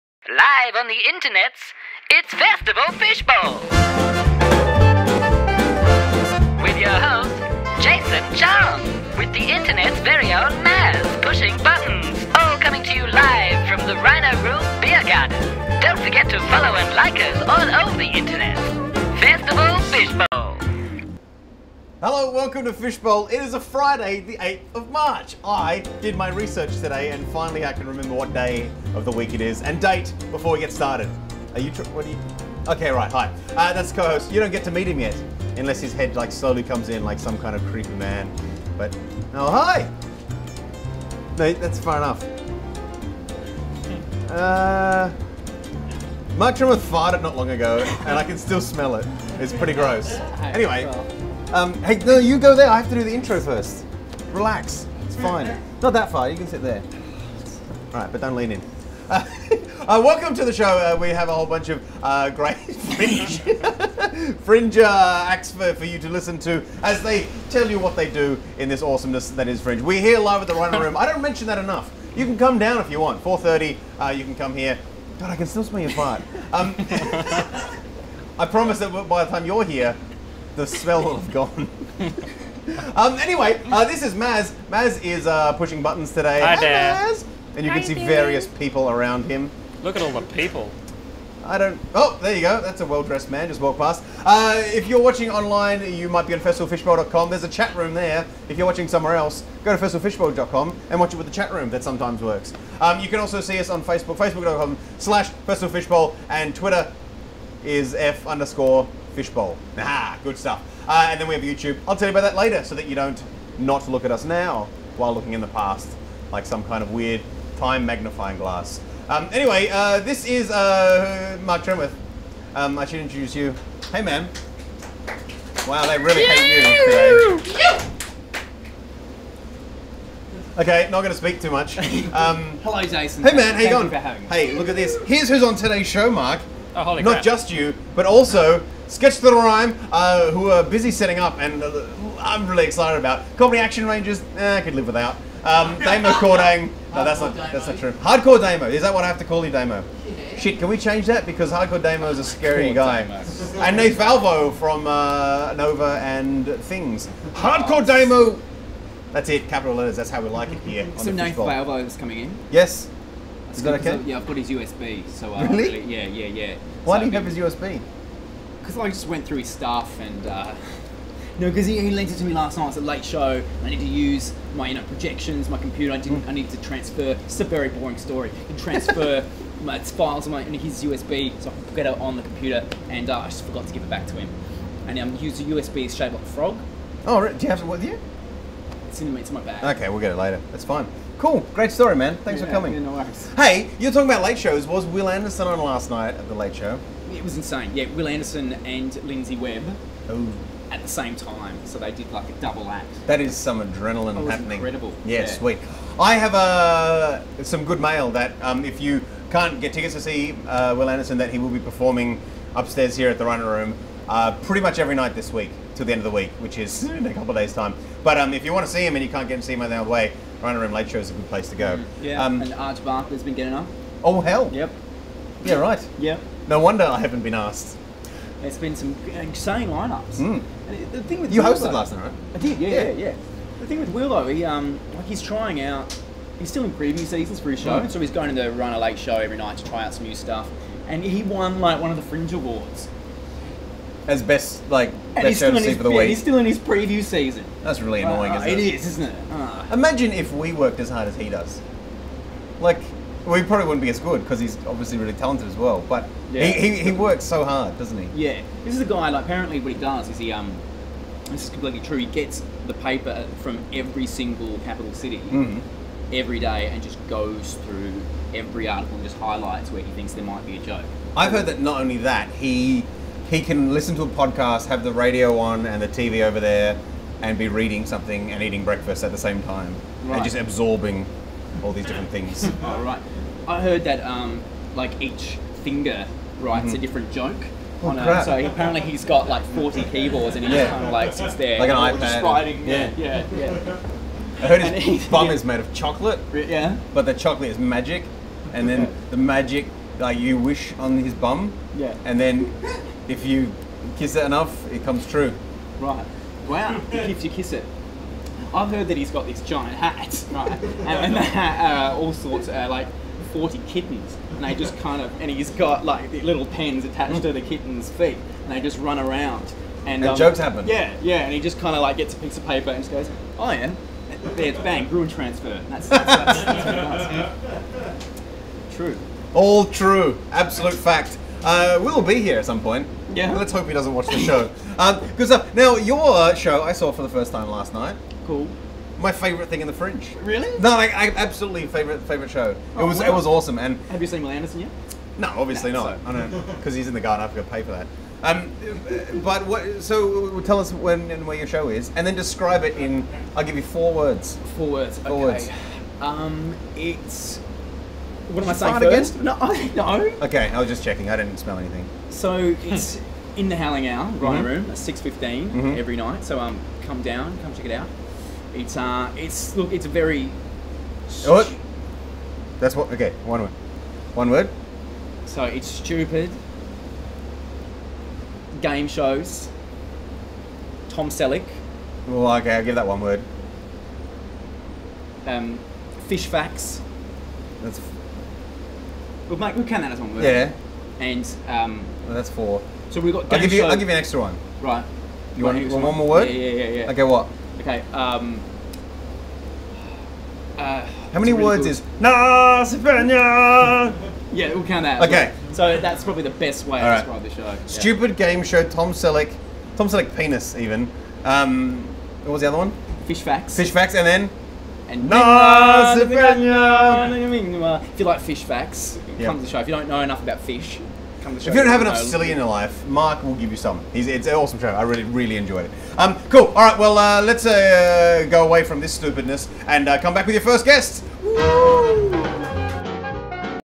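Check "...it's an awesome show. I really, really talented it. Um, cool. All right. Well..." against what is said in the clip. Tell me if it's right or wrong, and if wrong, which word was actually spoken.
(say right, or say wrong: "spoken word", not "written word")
wrong: "enjoyed", not "talented".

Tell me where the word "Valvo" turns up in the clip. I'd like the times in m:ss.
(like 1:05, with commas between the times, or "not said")
2:33, 2:41.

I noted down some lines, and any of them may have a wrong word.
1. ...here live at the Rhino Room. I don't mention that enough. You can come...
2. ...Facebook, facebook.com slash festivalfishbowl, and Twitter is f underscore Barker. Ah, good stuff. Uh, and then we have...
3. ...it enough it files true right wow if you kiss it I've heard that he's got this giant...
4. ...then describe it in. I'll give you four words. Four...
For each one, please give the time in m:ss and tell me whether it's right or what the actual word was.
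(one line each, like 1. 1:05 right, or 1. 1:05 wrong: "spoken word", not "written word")
1. 1:09 right
2. 1:43 wrong: "Fishbowl", not "Barker"
3. 5:04 wrong: "comes", not "files"
4. 5:52 right.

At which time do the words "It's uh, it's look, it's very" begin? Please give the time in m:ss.
6:08.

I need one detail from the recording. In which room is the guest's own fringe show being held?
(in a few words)
The Howling Owl.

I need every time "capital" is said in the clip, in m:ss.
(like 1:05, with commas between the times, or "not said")
2:39, 4:24.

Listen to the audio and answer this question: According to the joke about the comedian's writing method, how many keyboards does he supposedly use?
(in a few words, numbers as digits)
40.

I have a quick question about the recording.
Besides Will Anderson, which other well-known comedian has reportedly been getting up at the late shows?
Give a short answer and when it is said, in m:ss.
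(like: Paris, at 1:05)
Arj Barker, at 3:42.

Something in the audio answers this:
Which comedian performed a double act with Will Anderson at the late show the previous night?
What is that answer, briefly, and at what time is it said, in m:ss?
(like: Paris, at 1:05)
Lindsay Webb, at 3:19.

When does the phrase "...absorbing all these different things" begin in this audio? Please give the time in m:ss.
4:40.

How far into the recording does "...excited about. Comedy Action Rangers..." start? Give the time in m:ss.
2:22.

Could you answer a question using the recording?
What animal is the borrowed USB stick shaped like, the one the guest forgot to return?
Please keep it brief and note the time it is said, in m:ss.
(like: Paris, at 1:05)
A frog, at 3:06.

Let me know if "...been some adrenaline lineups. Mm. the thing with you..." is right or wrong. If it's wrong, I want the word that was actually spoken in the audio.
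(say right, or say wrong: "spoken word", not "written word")
wrong: "insane", not "adrenaline".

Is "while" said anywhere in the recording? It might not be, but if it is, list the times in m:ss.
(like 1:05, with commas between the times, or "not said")
1:54.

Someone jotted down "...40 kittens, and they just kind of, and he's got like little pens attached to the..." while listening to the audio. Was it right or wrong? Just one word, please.
right.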